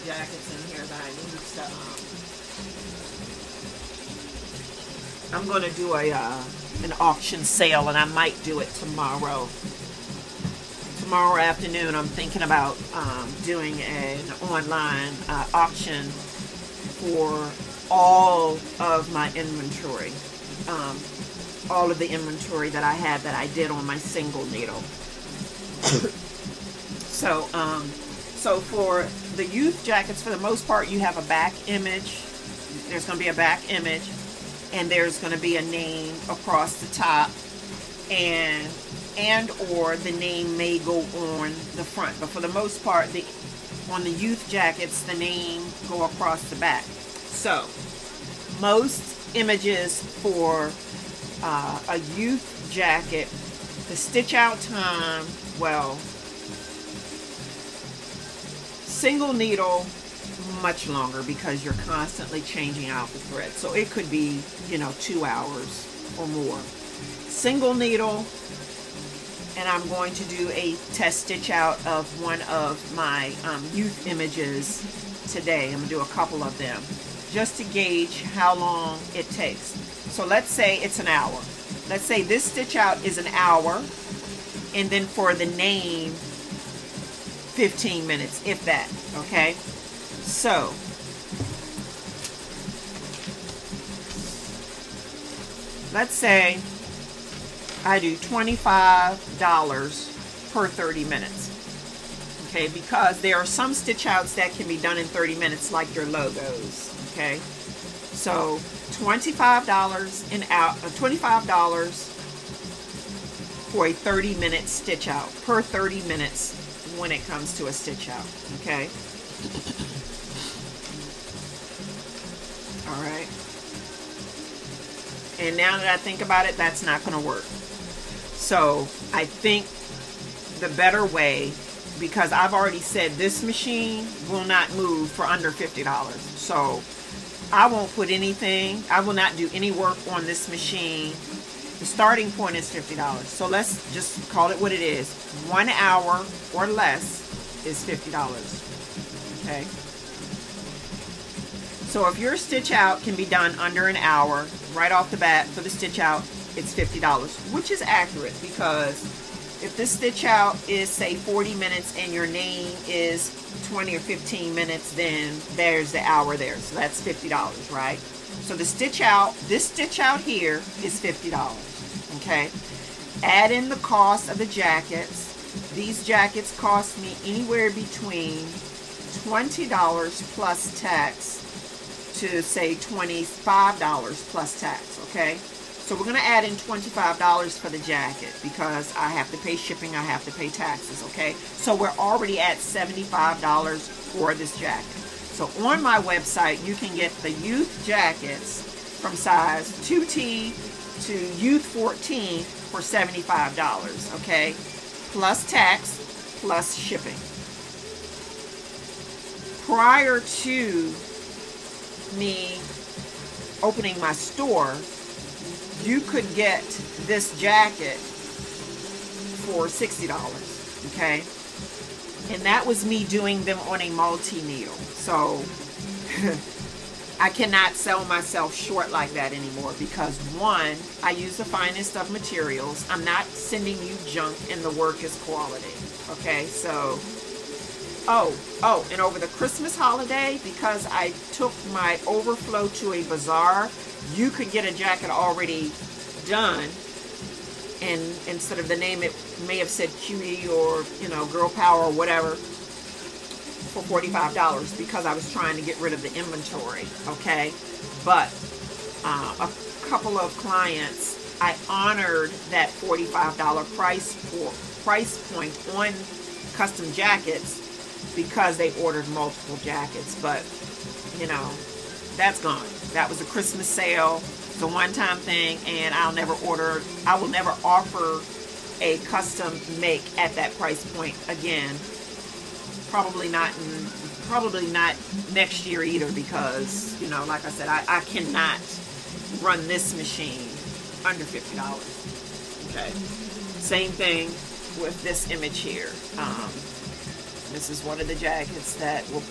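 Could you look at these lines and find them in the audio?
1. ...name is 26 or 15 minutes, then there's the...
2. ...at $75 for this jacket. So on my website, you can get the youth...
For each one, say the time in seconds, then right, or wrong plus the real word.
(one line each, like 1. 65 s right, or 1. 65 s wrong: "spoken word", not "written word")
1. 162 s wrong: "20", not "26"
2. 192 s right.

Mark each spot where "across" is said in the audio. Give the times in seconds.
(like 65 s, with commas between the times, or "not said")
36 s, 46 s.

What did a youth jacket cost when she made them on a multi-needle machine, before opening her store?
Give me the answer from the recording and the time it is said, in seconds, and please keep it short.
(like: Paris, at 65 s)
$60, at 219 s.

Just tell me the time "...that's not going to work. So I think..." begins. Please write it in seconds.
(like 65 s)
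126 s.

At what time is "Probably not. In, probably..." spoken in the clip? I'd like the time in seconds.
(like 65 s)
282 s.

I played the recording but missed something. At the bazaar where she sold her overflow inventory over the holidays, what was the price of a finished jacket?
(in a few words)
$45.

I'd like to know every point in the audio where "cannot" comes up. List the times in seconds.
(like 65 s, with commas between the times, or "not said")
227 s, 288 s.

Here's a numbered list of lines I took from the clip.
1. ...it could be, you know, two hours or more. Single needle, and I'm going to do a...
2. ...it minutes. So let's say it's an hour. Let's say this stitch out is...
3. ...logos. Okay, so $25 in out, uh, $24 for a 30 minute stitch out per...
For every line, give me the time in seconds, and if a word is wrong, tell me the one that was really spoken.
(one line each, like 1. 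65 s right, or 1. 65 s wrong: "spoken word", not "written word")
1. 63 s right
2. 79 s wrong: "takes", not "minutes"
3. 106 s wrong: "25", not "24".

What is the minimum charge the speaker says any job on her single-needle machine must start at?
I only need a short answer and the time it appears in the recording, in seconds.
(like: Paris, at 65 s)
$50, at 141 s.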